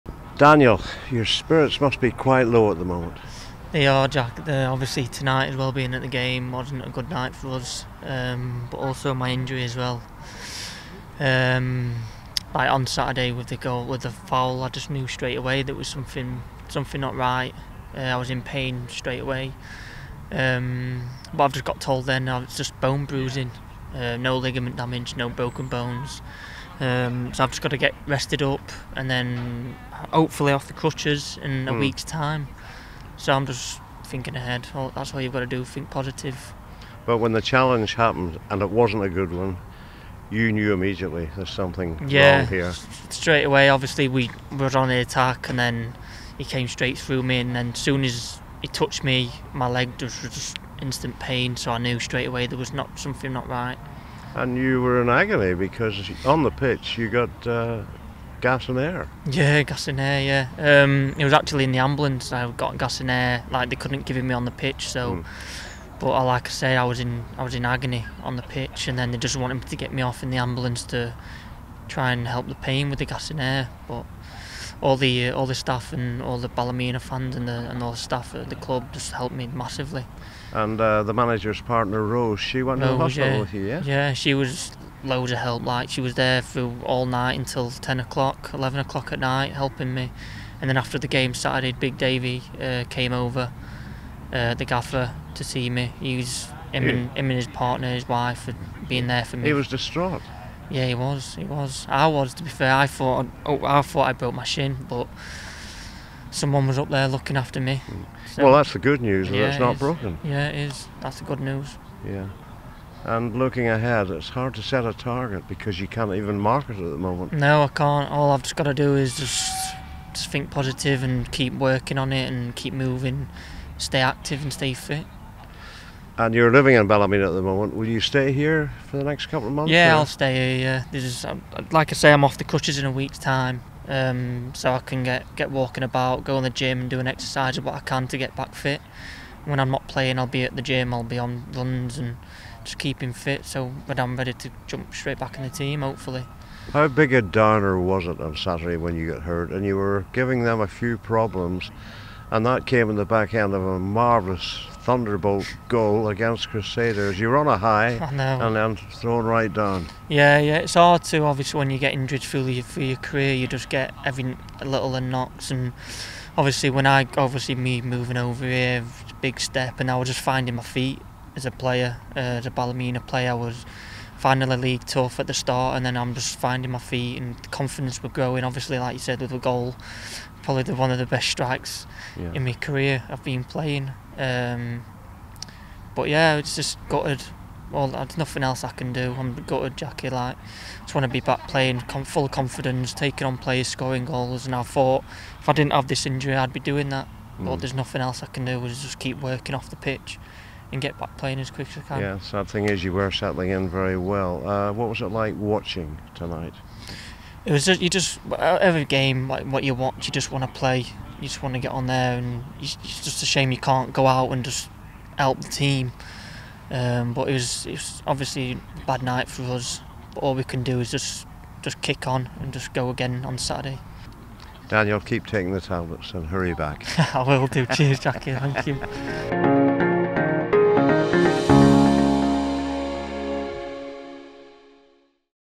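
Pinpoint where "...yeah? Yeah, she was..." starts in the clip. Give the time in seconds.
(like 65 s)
83 s.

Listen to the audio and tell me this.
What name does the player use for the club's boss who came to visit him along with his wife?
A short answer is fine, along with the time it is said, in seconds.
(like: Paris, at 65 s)
Big Davy, at 91 s.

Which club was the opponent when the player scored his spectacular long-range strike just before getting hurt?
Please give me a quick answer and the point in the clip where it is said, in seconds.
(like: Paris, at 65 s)
Crusaders, at 156 s.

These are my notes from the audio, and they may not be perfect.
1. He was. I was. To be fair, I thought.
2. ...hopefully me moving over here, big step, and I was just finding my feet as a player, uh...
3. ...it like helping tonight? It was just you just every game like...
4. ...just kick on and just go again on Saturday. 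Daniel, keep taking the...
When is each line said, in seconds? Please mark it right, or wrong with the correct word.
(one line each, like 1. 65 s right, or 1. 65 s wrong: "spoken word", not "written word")
1. 101 s right
2. 167 s wrong: "obviously", not "hopefully"
3. 205 s wrong: "watching", not "helping"
4. 221 s right.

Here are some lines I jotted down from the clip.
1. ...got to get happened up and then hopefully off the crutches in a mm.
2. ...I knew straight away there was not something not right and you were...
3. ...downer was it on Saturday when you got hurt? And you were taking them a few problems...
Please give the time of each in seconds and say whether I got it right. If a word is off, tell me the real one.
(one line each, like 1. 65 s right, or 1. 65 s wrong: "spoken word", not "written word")
1. 27 s wrong: "rested", not "happened"
2. 51 s right
3. 147 s wrong: "giving", not "taking".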